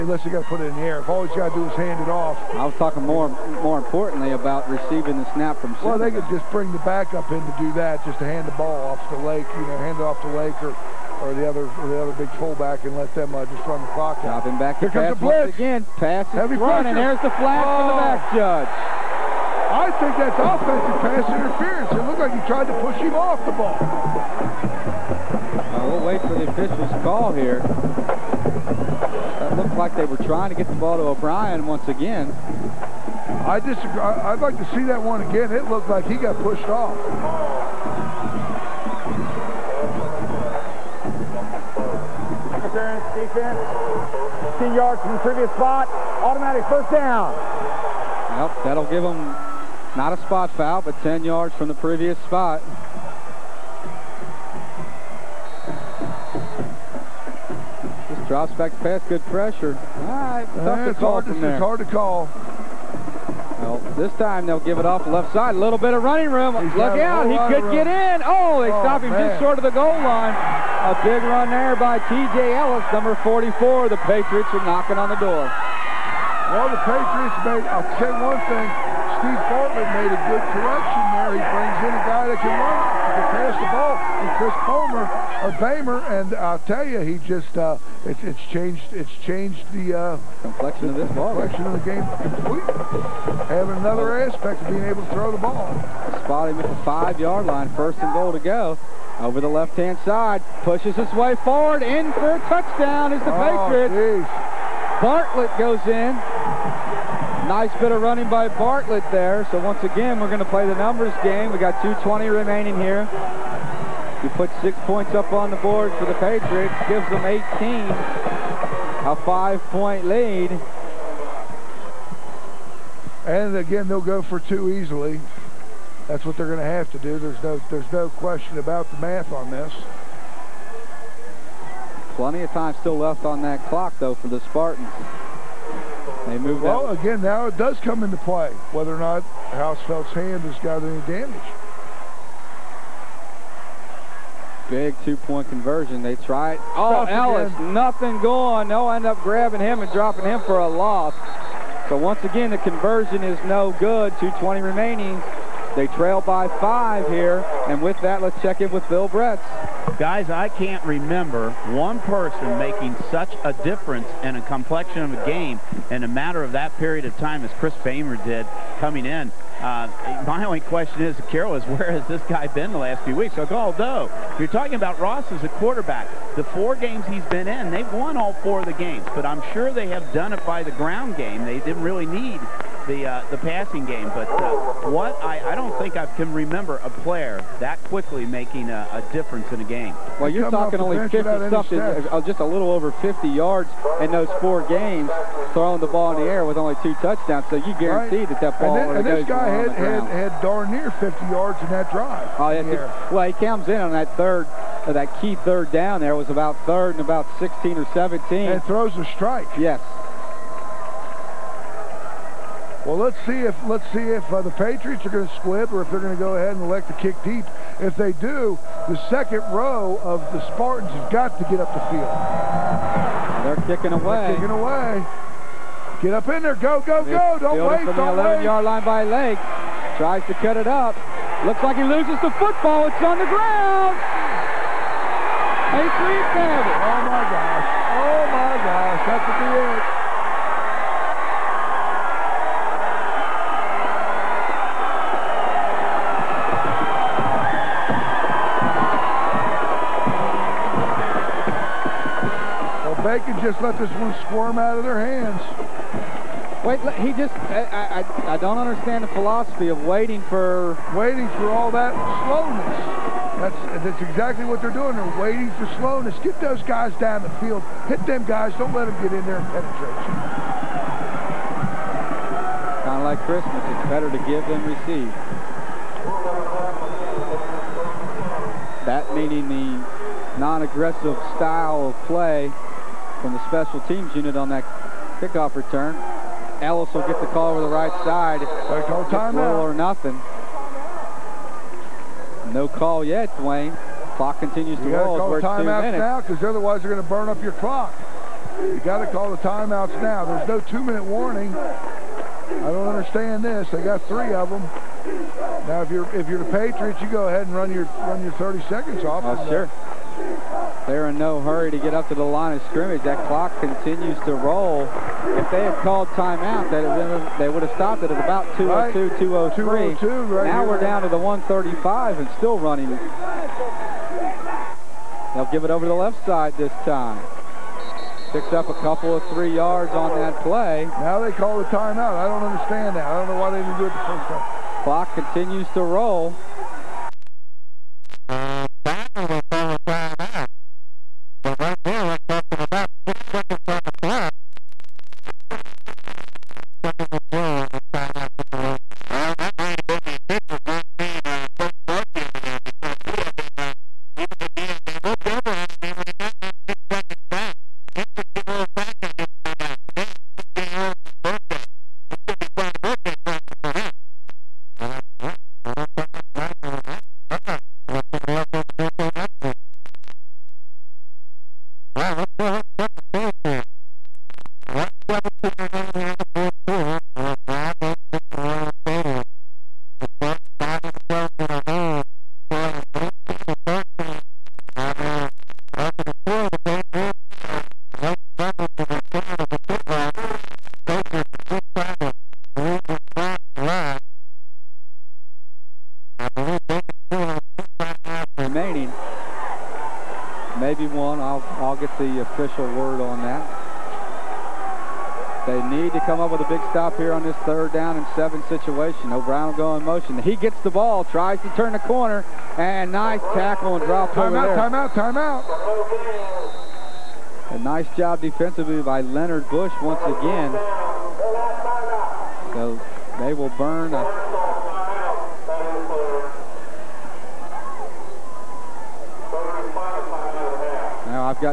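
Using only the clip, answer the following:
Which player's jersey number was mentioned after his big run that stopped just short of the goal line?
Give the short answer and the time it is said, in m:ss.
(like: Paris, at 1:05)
44, at 1:12.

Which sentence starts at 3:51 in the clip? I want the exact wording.
Looks like he loses the football.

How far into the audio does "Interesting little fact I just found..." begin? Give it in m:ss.
5:57.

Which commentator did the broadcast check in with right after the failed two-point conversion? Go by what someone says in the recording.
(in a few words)
Bill Bretz.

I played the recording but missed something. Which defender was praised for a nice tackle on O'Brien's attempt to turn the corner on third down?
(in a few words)
Leonard Bush.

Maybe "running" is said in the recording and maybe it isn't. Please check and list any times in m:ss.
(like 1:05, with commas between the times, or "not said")
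1:06, 1:48, 5:22.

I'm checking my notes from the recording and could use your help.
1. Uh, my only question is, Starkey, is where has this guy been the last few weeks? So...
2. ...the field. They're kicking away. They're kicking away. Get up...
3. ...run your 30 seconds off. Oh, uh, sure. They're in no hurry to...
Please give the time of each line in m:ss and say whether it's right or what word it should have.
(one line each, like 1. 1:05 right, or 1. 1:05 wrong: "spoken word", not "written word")
1. 2:49 wrong: "Carroll", not "Starkey"
2. 3:41 right
3. 5:07 right.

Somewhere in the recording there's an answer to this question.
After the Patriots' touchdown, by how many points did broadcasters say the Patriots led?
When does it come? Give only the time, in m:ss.
1:57.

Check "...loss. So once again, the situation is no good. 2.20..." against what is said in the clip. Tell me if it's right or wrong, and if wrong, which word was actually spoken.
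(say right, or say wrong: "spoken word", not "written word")
wrong: "conversion", not "situation".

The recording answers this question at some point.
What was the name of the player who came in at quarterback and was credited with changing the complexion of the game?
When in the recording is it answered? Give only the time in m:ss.
1:24.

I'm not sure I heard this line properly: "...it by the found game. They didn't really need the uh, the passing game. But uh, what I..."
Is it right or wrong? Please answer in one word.
wrong.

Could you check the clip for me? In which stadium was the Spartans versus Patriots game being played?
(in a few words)
Brown Batesvich Memorial Stadium.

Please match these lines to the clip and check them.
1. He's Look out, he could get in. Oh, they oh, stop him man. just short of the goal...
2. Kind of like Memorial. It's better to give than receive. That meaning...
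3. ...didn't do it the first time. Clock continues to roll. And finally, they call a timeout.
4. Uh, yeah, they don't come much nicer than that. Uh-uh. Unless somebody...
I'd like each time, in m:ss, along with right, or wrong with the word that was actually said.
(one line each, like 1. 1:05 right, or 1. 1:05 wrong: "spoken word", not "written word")
1. 1:06 right
2. 4:32 wrong: "Christmas", not "Memorial"
3. 5:33 right
4. 6:04 right.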